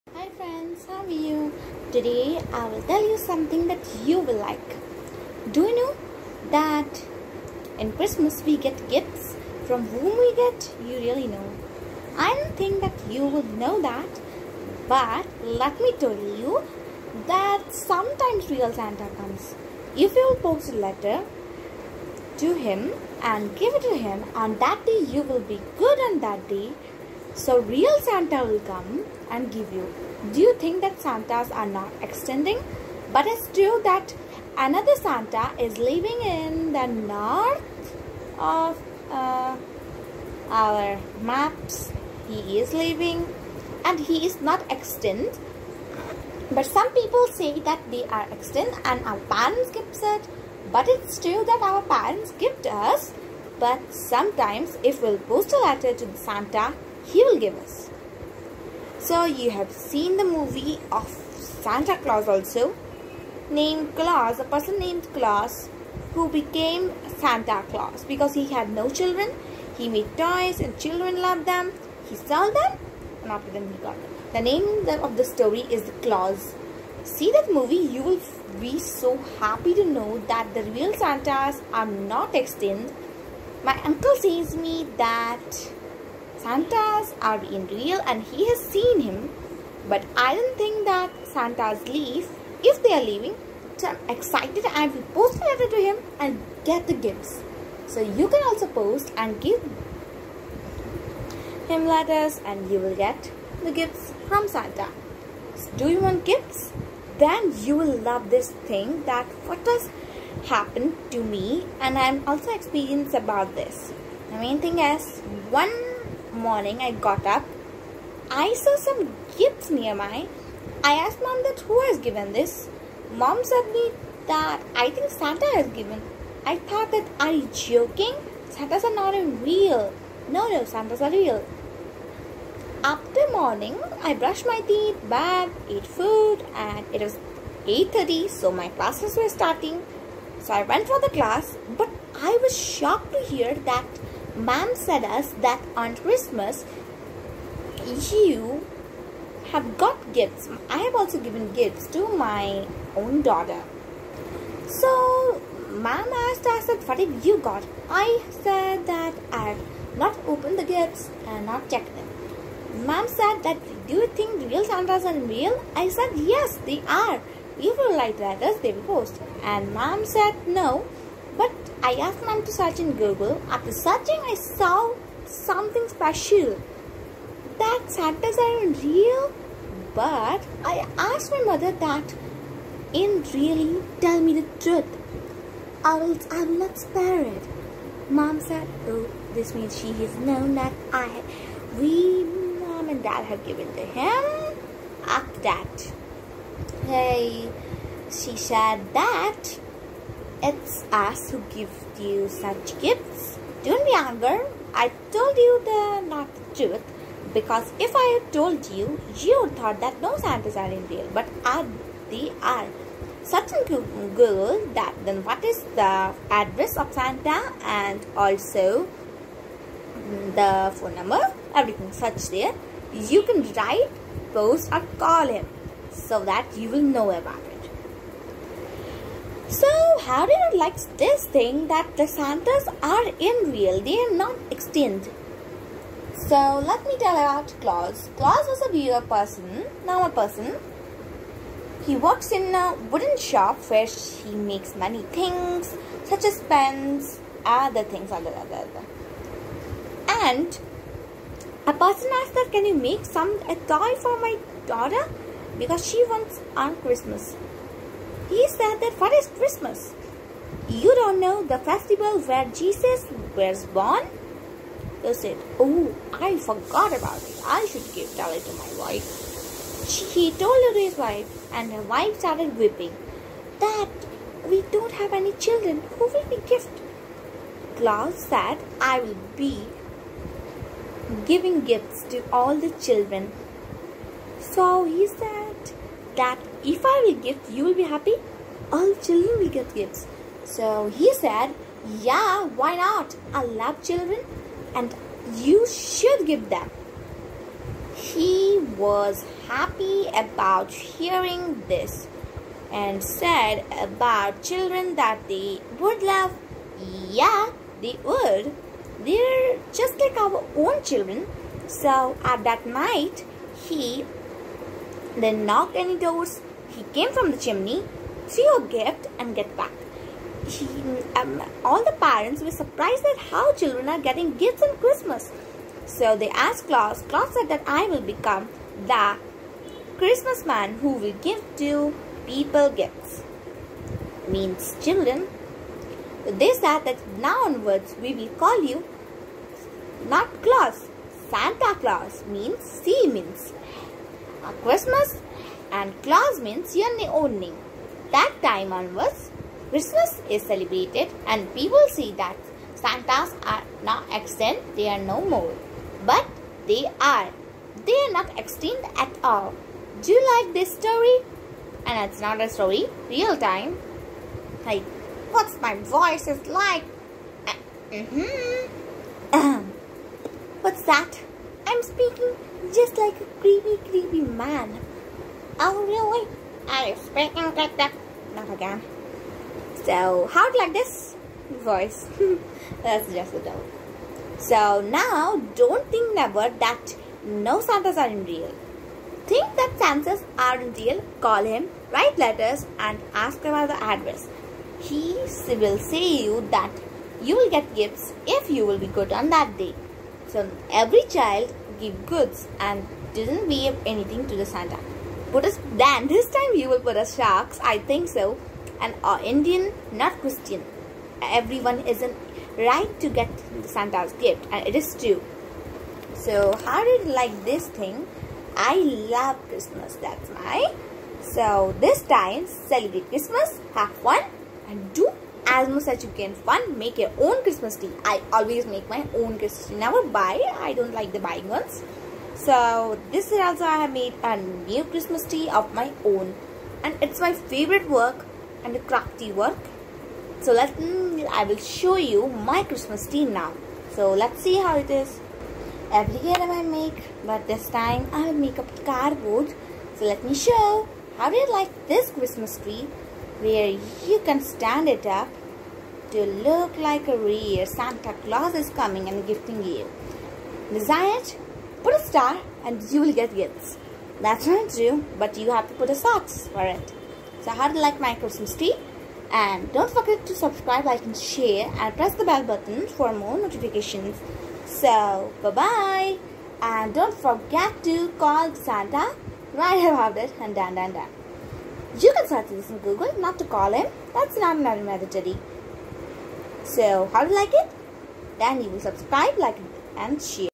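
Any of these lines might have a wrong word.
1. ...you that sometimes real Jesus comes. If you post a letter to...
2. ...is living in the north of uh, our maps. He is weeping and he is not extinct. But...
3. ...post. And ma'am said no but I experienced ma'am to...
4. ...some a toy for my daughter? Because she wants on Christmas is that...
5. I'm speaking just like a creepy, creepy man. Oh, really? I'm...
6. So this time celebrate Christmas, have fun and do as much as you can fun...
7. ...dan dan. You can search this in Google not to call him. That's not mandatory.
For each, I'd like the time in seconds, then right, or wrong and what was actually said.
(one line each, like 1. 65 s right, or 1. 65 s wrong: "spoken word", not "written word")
1. 16 s wrong: "Santa", not "Jesus"
2. 35 s wrong: "living", not "weeping"
3. 168 s wrong: "asked", not "experienced"
4. 253 s right
5. 371 s right
6. 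421 s right
7. 480 s right.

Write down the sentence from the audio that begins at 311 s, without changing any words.
So at that night, he then knock any doors.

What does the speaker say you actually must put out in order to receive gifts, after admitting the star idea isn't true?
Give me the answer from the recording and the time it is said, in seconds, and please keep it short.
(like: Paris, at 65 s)
socks, at 465 s.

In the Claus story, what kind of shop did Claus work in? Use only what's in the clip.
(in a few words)
wooden shop.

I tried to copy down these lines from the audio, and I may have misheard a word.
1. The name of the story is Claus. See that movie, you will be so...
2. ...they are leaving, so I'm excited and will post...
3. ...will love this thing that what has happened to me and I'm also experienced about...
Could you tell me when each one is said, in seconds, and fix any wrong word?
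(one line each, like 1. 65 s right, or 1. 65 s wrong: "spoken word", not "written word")
1. 74 s right
2. 92 s right
3. 107 s right.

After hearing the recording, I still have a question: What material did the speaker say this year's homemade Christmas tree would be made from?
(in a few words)
cardboard.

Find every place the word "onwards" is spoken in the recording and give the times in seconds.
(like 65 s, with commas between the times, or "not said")
337 s, 348 s.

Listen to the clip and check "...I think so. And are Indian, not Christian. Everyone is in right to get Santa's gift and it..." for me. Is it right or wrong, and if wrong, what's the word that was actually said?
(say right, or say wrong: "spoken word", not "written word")
right.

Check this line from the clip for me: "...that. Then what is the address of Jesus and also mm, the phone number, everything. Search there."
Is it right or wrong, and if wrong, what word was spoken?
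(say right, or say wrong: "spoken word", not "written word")
wrong: "Santa", not "Jesus".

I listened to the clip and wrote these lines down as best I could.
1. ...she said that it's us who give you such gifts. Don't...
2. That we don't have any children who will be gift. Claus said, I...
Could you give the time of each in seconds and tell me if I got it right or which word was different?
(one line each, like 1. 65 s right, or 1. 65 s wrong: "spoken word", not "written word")
1. 198 s right
2. 273 s right.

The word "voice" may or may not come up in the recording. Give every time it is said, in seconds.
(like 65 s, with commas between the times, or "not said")
365 s, 381 s.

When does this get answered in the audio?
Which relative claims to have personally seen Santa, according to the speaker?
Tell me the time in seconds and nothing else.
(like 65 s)
83 s.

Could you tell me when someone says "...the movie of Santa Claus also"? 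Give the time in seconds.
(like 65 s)
60 s.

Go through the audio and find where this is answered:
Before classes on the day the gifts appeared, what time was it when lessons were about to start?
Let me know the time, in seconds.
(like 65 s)
137 s.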